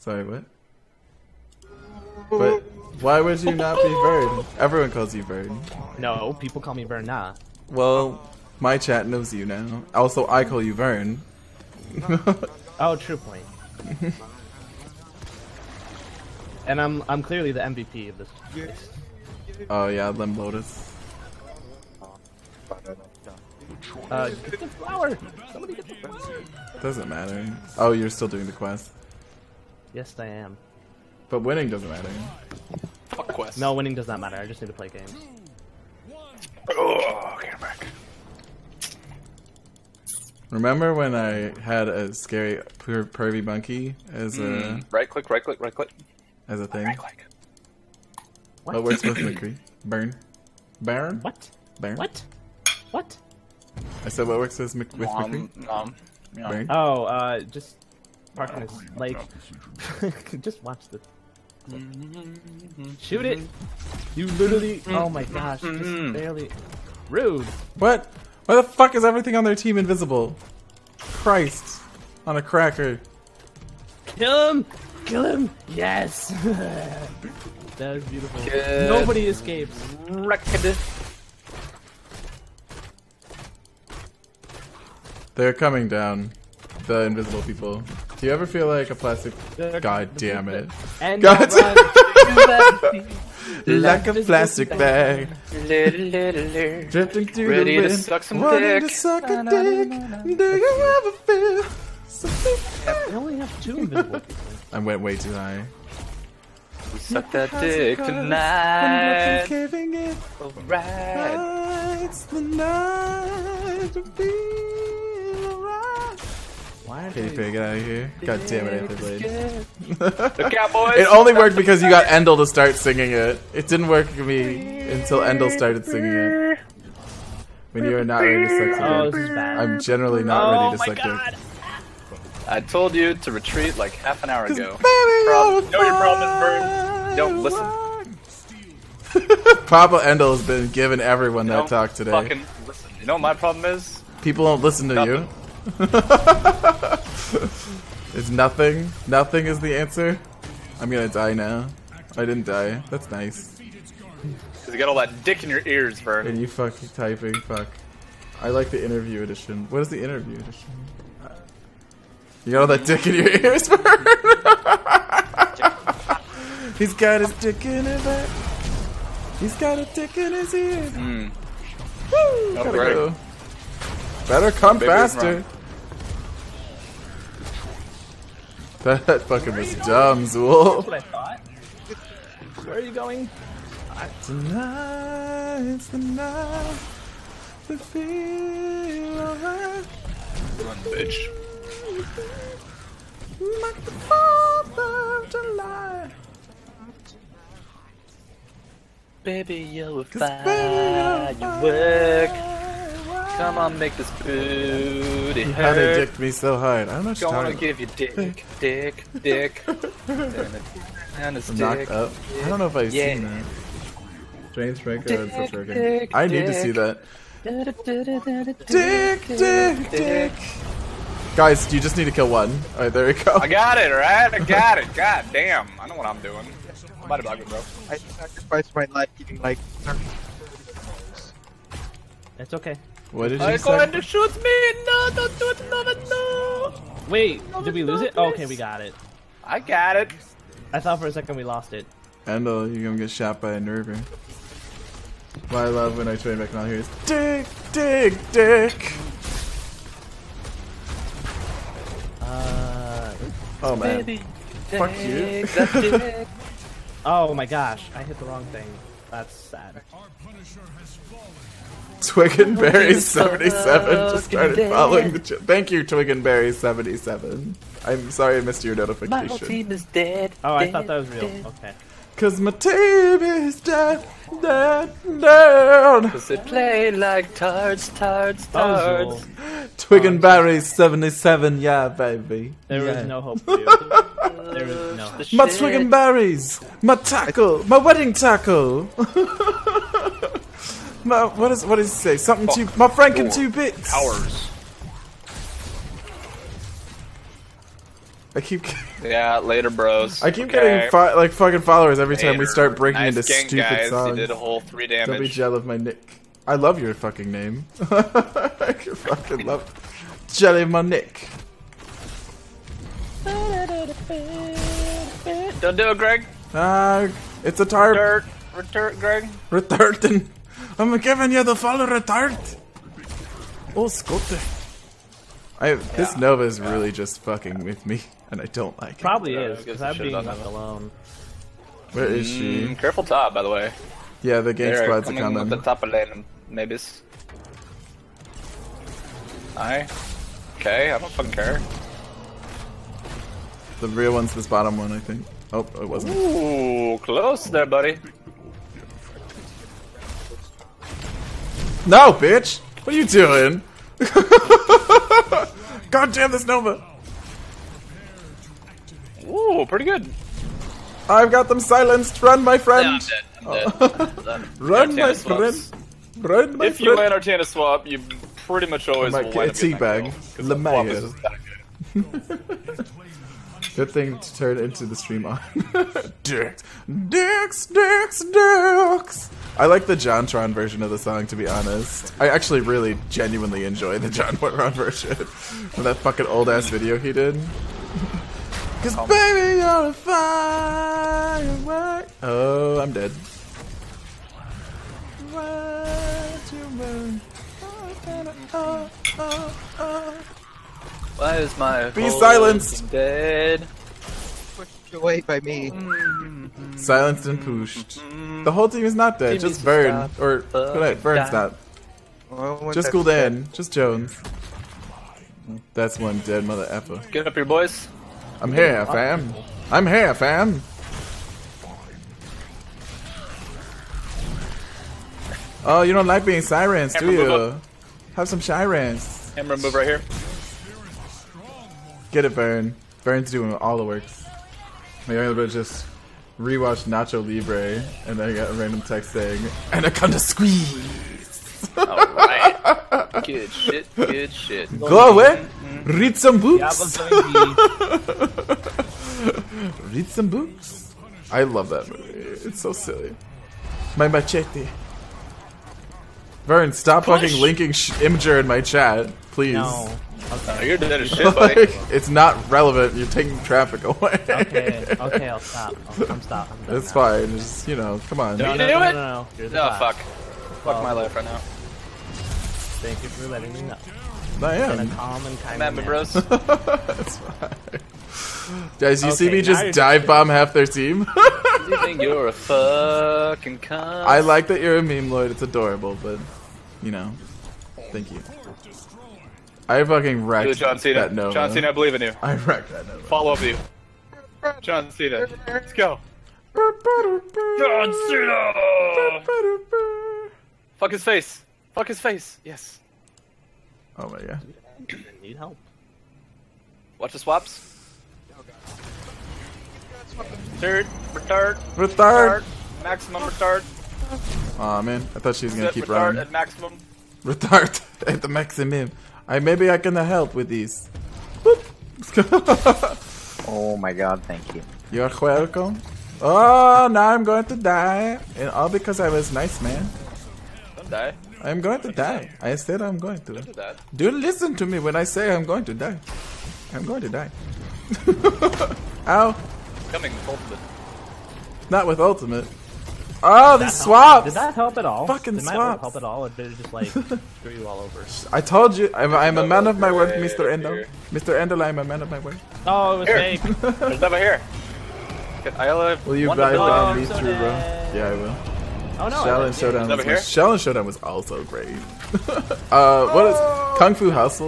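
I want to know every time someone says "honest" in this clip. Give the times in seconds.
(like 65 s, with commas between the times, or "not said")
381 s.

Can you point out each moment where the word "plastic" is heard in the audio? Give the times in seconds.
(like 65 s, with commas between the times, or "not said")
88 s, 94 s.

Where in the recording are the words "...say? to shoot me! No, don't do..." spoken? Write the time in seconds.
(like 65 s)
233 s.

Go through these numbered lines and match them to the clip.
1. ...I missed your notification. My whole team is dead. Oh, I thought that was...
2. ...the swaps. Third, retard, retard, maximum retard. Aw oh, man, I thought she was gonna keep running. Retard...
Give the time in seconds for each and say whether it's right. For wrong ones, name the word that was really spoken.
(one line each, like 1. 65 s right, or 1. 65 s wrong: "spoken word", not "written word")
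1. 268 s right
2. 507 s right.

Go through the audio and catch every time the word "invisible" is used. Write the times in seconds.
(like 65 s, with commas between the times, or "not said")
69 s, 87 s, 103 s.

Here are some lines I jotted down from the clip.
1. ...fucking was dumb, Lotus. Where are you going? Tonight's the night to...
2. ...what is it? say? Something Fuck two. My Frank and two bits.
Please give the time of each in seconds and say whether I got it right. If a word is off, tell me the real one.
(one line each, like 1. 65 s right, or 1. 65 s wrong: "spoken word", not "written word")
1. 179 s wrong: "Zool", not "Lotus"
2. 291 s right.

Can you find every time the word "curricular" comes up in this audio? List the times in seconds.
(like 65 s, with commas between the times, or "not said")
not said.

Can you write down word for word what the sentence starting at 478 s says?
Guys, you okay, see me just dive bomb half their team?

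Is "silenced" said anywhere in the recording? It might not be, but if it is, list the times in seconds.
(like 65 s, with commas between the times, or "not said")
361 s, 402 s, 406 s.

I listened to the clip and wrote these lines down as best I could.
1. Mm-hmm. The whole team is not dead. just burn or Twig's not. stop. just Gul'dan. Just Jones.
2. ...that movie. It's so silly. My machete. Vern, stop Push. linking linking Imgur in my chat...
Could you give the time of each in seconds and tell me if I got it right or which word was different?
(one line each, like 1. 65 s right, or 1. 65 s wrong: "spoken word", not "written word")
1. 408 s wrong: "Burn", not "Twig"
2. 451 s wrong: "fucking", not "linking".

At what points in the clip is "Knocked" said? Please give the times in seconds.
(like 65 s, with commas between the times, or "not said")
211 s.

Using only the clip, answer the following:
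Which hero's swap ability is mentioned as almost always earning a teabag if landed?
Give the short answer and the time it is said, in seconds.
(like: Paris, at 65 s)
Artanis, at 367 s.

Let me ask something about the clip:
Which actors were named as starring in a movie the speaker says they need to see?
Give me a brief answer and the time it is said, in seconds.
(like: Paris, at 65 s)
James Franco and Seth Rogen, at 214 s.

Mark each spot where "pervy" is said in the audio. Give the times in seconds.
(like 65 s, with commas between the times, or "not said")
43 s.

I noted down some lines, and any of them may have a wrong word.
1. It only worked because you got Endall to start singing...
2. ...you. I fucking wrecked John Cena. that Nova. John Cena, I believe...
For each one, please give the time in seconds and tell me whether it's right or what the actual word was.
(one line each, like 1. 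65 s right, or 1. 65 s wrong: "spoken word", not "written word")
1. 120 s right
2. 488 s right.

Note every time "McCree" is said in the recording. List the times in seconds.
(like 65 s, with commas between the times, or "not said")
49 s, 55 s.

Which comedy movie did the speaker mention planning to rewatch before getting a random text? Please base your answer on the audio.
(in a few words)
Nacho Libre.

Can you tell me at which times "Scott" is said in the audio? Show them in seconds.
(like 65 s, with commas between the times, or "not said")
323 s.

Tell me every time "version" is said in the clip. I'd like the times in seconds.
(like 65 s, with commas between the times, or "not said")
380 s, 384 s.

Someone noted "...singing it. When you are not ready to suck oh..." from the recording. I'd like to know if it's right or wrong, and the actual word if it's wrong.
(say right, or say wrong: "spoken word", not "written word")
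right.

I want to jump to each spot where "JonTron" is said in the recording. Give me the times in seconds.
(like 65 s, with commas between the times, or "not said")
379 s, 384 s.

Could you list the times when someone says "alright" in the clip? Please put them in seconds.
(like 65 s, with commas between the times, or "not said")
110 s, 189 s, 222 s, 441 s.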